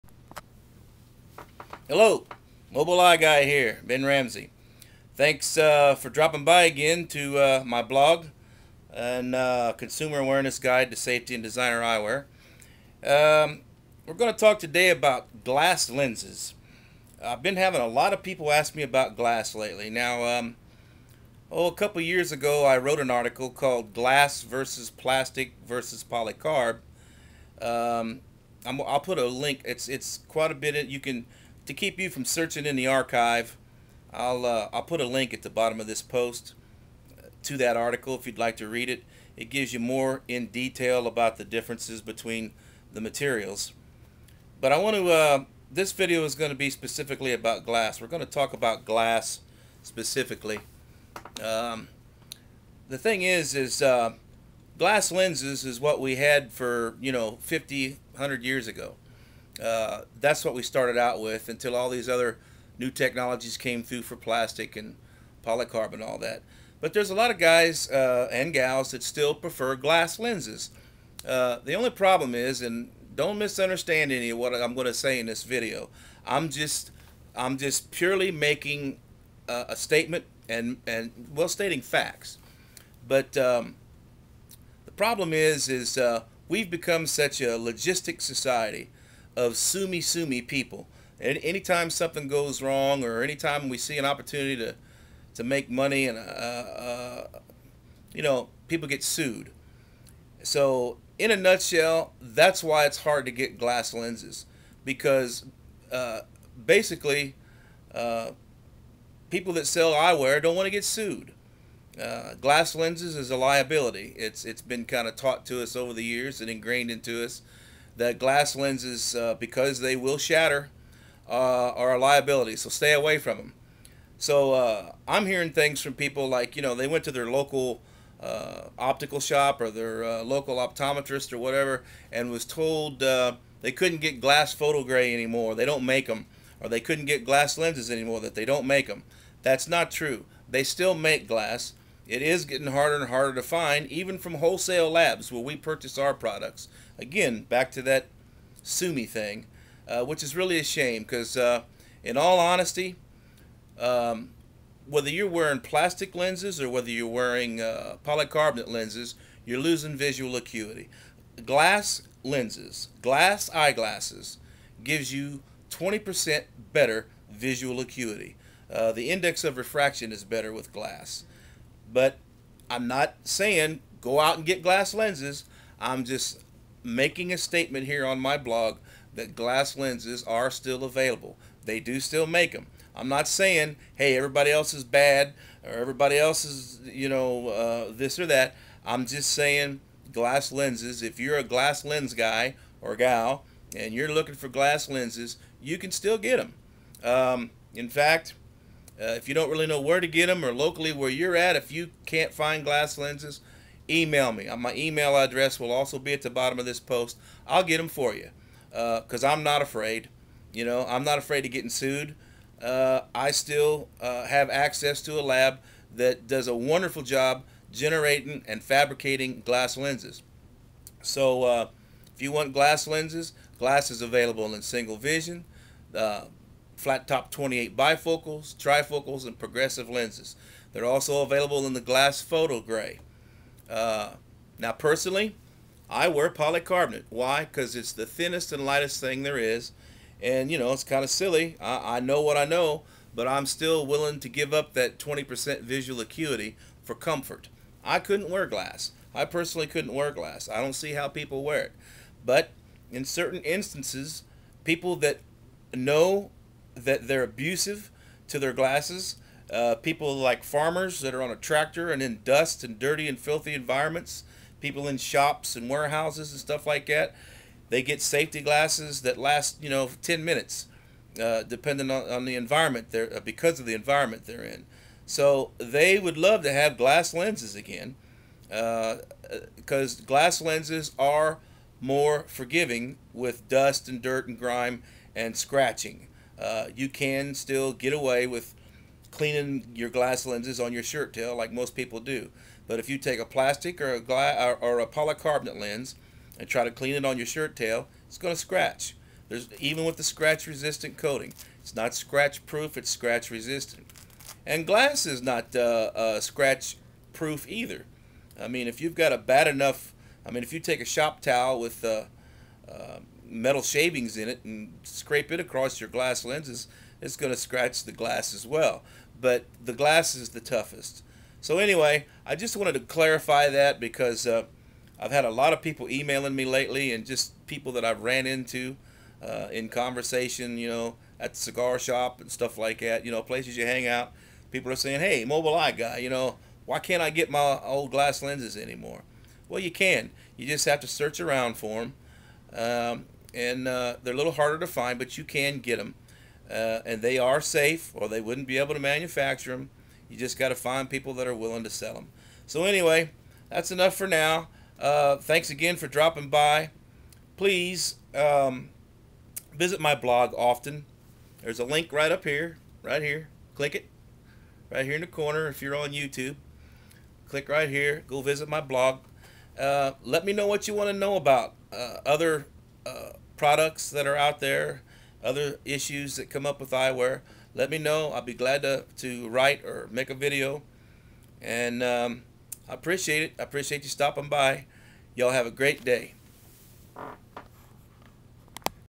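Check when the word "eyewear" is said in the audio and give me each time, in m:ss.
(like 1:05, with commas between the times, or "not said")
0:11, 1:49, 6:16.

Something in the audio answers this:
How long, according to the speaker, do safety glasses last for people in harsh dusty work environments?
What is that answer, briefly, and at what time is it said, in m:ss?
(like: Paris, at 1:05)
10 minutes, at 4:30.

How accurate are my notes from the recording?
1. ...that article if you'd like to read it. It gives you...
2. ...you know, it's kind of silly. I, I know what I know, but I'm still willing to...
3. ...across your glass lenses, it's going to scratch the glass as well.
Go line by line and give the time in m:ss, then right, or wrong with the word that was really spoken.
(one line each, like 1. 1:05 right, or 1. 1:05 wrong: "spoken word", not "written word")
1. 0:37 right
2. 4:00 right
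3. 5:15 right.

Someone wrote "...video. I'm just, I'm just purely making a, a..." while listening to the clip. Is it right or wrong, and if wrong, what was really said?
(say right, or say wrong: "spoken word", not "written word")
right.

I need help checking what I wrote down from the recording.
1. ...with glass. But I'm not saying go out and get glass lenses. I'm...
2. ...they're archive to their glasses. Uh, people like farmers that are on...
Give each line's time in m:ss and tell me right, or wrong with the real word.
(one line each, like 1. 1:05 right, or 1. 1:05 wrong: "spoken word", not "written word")
1. 2:50 right
2. 4:17 wrong: "abusive", not "archive".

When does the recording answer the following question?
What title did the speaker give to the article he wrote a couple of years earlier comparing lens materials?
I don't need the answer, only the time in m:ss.
0:23.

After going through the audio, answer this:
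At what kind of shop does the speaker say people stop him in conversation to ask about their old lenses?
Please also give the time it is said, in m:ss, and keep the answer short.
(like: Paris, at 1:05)
cigar shop, at 5:31.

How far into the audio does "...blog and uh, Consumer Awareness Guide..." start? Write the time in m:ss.
0:07.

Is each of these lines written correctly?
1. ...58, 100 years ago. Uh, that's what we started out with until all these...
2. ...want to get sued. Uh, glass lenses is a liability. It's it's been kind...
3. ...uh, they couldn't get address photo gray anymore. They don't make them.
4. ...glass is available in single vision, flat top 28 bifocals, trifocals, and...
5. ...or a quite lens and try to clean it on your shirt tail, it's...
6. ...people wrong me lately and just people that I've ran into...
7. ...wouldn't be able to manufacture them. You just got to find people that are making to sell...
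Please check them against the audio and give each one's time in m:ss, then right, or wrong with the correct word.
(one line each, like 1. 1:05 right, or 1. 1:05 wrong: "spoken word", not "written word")
1. 0:57 wrong: "50", not "58"
2. 1:50 right
3. 2:13 wrong: "glass", not "address"
4. 3:43 right
5. 4:54 wrong: "polycarbonate", not "quite"
6. 5:25 wrong: "emailing", not "wrong"
7. 5:48 wrong: "willing", not "making".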